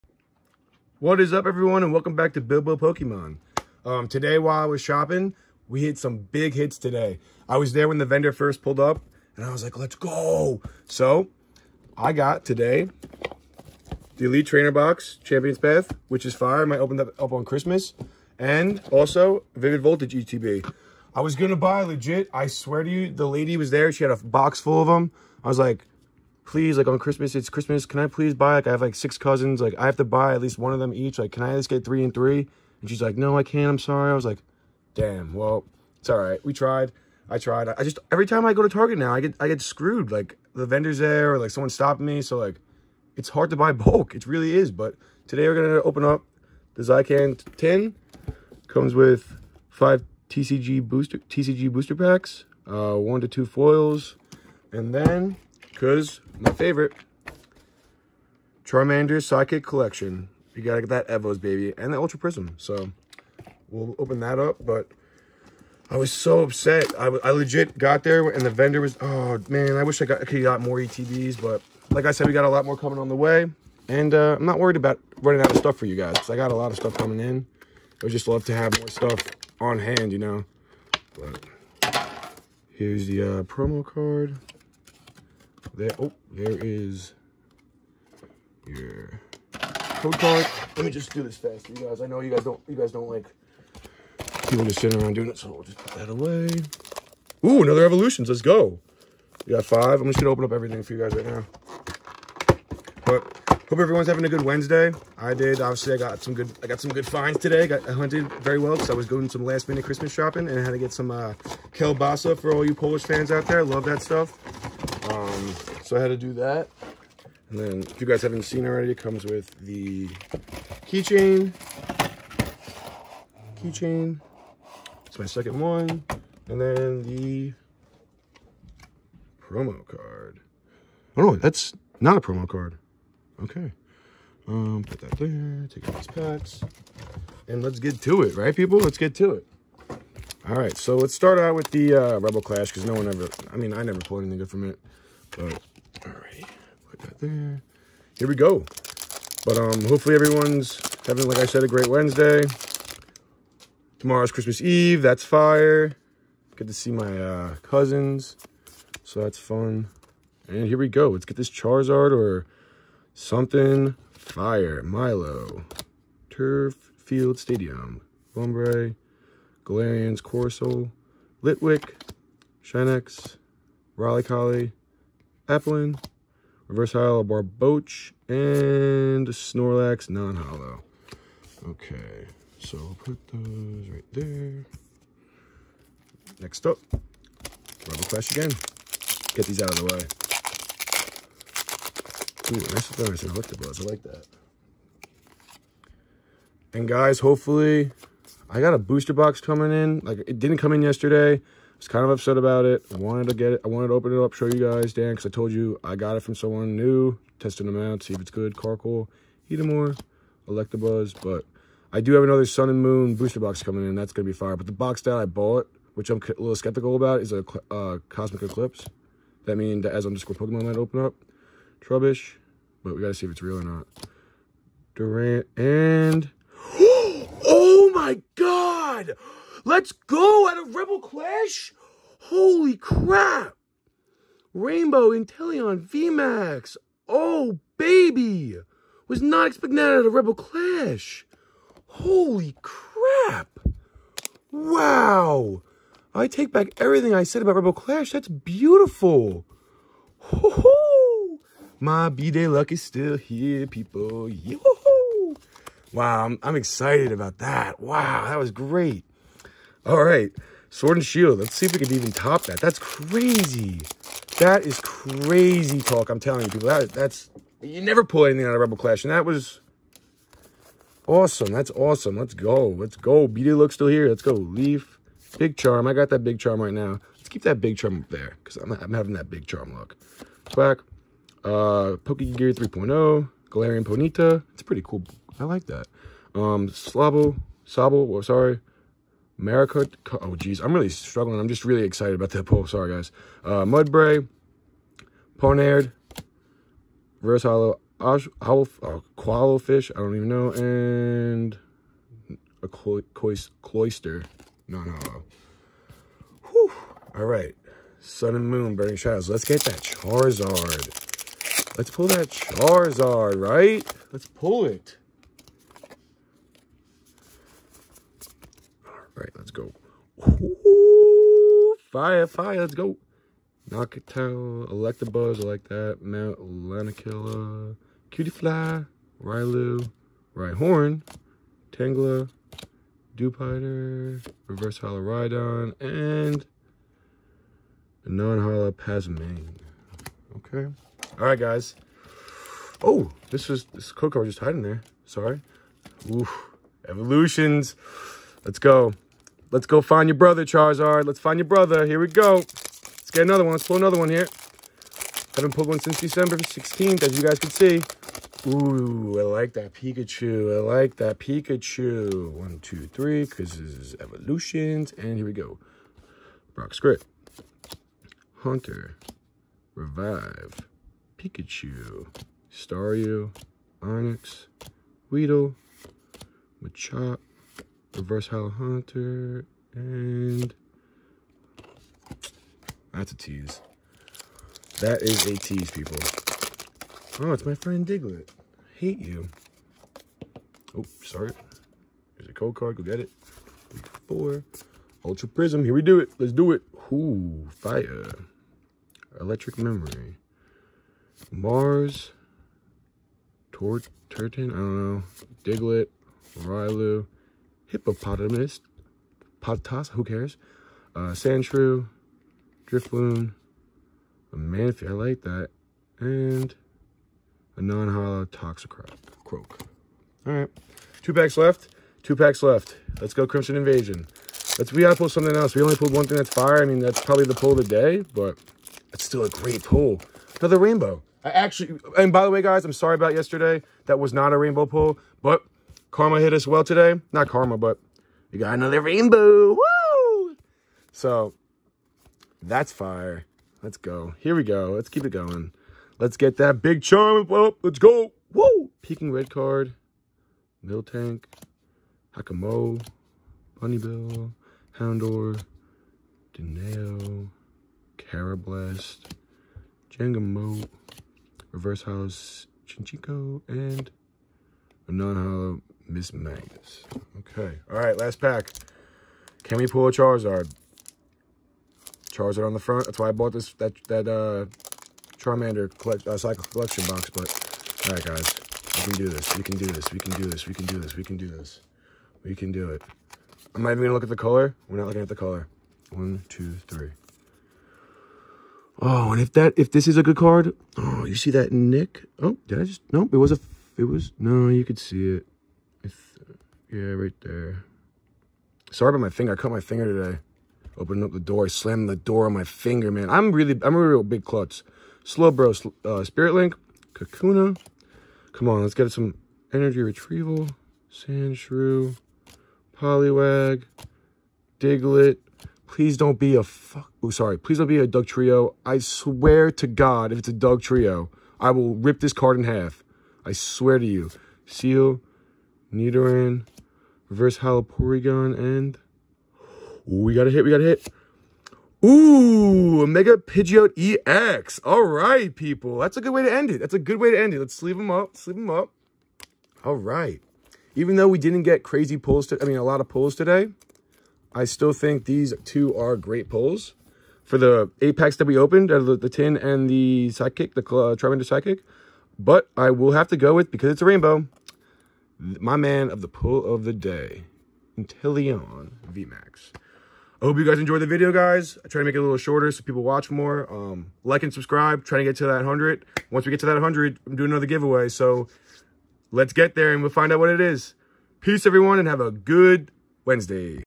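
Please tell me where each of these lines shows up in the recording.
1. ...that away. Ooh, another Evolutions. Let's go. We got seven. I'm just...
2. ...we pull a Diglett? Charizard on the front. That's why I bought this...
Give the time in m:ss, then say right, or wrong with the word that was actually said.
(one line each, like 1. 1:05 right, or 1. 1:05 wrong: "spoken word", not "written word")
1. 1:35 wrong: "five", not "seven"
2. 7:49 wrong: "Charizard", not "Diglett".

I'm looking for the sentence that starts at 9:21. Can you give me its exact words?
I try to make it a little shorter so people watch more.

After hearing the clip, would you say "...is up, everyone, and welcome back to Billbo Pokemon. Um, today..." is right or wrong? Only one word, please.
right.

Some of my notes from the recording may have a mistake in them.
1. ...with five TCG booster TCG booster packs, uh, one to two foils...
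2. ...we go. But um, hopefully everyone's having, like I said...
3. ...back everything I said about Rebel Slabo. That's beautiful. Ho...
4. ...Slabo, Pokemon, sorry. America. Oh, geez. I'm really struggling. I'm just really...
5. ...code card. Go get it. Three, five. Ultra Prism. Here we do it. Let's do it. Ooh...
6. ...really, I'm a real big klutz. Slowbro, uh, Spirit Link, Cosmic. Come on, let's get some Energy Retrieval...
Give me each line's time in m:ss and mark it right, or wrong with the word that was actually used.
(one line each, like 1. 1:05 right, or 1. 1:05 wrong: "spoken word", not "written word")
1. 0:48 right
2. 2:28 right
3. 4:06 wrong: "Clash", not "Slabo"
4. 4:46 wrong: "Sabo", not "Pokemon"
5. 6:32 wrong: "four", not "five"
6. 8:23 wrong: "Kakuna", not "Cosmic".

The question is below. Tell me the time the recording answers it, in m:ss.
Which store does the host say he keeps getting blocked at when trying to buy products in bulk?
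0:38.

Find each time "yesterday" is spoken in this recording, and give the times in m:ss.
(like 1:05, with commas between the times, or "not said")
3:20, 7:13.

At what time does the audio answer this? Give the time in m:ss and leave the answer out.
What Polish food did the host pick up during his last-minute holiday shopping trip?
1:51.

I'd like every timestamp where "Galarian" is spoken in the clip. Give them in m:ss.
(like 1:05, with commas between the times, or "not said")
2:49, 4:43.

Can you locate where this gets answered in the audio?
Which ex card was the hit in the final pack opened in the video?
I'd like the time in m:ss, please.
8:52.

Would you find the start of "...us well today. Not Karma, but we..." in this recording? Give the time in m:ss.
7:16.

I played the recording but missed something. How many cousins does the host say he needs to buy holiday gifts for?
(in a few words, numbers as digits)
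6.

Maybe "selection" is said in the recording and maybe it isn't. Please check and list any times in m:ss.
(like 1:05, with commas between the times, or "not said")
not said.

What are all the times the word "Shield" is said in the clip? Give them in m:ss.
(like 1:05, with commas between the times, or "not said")
4:21.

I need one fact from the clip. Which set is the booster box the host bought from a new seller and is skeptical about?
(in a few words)
Cosmic Eclipse.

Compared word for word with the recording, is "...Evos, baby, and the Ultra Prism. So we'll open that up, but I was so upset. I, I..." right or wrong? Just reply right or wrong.
right.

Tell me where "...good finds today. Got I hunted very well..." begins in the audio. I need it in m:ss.
1:46.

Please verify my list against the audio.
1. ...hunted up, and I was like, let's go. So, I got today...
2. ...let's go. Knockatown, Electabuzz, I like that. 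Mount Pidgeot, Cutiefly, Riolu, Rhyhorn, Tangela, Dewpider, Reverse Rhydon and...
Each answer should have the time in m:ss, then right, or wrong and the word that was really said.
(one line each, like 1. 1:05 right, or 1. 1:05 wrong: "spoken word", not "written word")
1. 0:08 wrong: "pulled", not "hunted"
2. 5:22 wrong: "Lanakila", not "Pidgeot".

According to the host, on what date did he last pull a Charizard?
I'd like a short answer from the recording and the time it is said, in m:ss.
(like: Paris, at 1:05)
December 16th, at 5:55.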